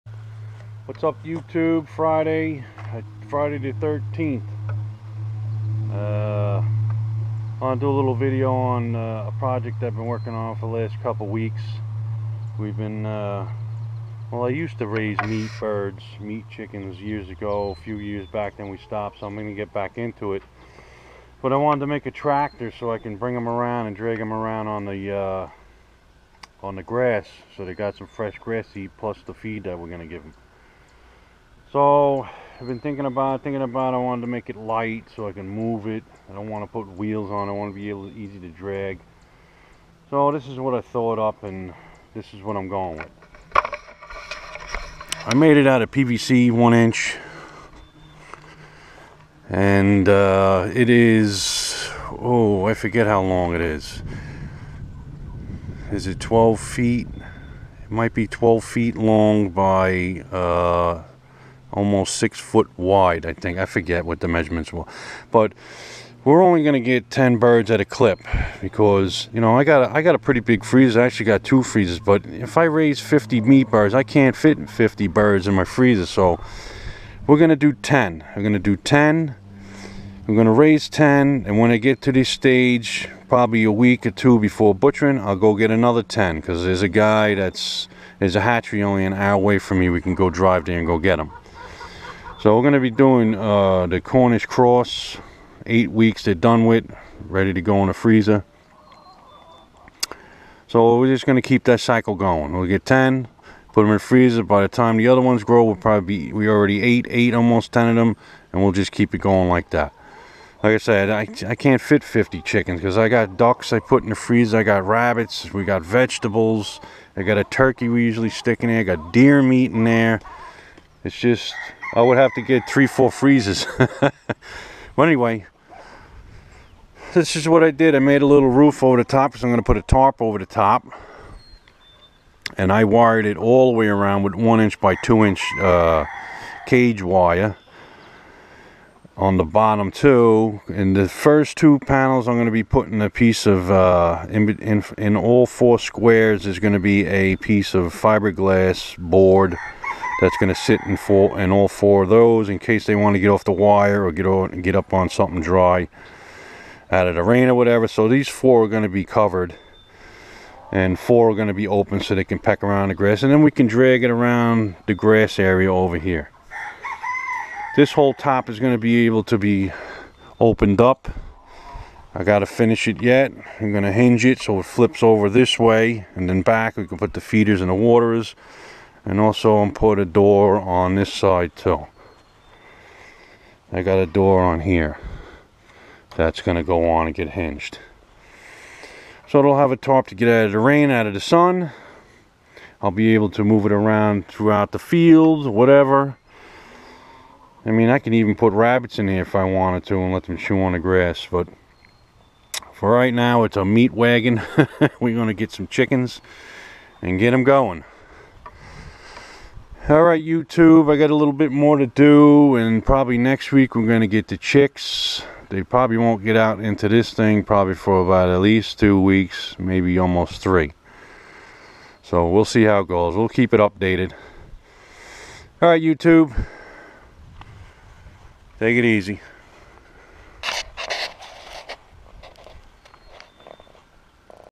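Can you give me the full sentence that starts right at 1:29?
We can go drive there and go get him.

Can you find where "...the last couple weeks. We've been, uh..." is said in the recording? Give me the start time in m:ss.
0:10.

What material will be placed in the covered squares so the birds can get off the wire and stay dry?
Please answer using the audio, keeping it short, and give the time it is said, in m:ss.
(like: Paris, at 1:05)
fiberglass board, at 2:27.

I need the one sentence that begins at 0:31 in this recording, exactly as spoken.
So I've been thinking about thinking about I wanted to make it light so I can move it.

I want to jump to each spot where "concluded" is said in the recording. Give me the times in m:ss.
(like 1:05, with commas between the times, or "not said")
not said.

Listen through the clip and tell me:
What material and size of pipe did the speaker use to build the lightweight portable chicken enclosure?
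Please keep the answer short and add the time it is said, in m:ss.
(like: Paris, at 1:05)
1-inch PVC, at 0:45.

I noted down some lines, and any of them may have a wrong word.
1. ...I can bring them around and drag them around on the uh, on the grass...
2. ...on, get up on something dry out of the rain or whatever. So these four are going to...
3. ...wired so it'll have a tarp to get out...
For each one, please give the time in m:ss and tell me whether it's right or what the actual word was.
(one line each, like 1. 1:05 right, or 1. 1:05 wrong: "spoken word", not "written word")
1. 0:22 right
2. 2:34 right
3. 3:07 wrong: "hinged", not "wired".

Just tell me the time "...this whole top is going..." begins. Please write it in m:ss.
2:47.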